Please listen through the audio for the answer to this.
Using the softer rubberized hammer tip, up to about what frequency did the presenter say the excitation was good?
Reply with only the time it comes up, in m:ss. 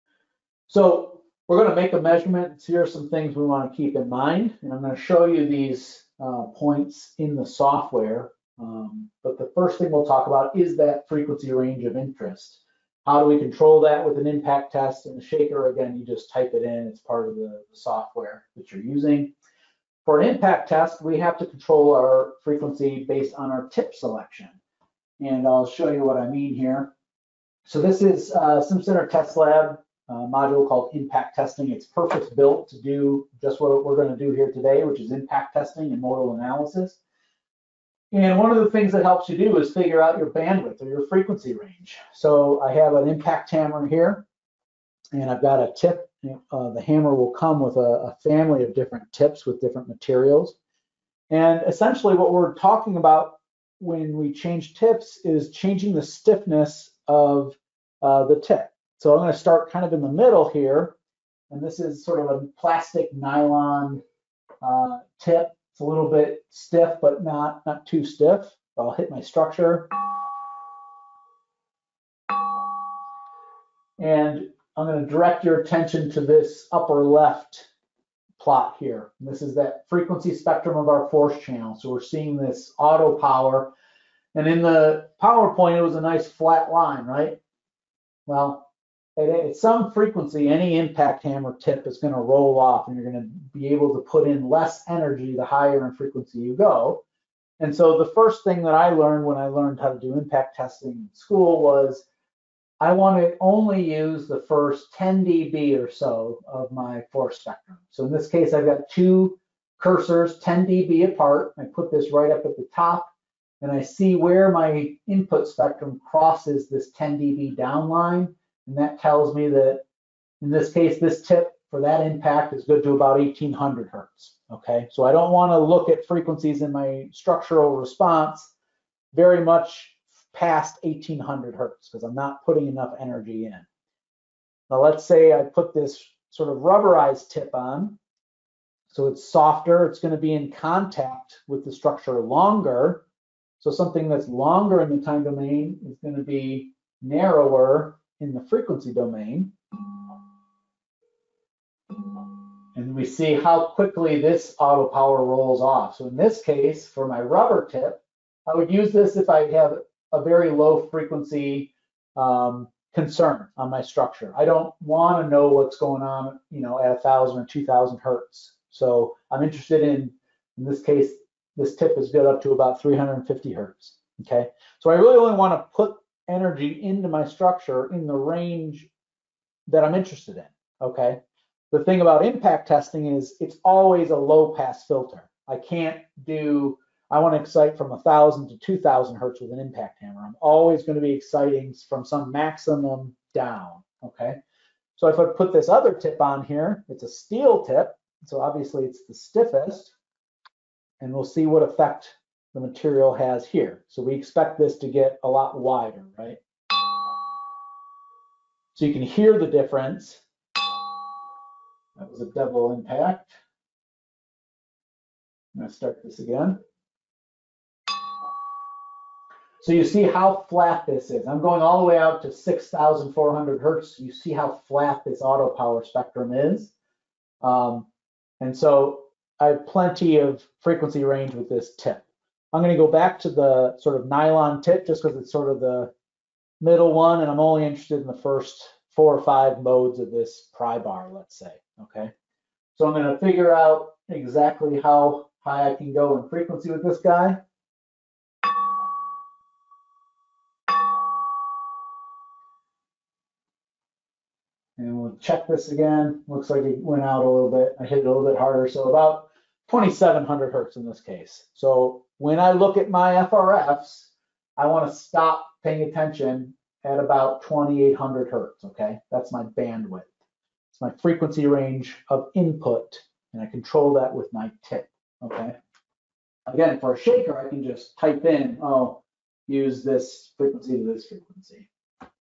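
2:52.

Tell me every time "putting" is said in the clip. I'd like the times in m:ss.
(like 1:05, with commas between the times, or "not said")
2:12.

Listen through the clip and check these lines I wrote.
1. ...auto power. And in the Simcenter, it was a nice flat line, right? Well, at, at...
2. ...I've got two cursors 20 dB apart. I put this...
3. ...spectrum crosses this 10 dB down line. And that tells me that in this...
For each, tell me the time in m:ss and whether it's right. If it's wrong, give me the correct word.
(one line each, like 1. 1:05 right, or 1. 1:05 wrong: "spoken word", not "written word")
1. 1:22 wrong: "PowerPoint", not "Simcenter"
2. 1:48 wrong: "10", not "20"
3. 1:55 right.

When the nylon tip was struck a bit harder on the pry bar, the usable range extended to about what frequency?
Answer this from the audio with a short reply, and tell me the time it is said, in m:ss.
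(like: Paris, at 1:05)
2700 hertz, at 4:19.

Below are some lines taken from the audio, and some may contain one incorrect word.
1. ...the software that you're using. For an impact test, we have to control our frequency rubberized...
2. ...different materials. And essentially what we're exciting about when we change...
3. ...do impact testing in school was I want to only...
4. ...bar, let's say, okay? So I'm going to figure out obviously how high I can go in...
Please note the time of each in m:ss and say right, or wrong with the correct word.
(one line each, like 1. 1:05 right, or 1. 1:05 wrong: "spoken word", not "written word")
1. 0:17 wrong: "based", not "rubberized"
2. 0:49 wrong: "talking", not "exciting"
3. 1:39 right
4. 4:00 wrong: "exactly", not "obviously".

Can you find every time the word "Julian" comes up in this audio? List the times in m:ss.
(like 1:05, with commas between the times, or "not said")
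not said.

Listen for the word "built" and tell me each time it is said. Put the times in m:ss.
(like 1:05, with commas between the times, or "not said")
0:32.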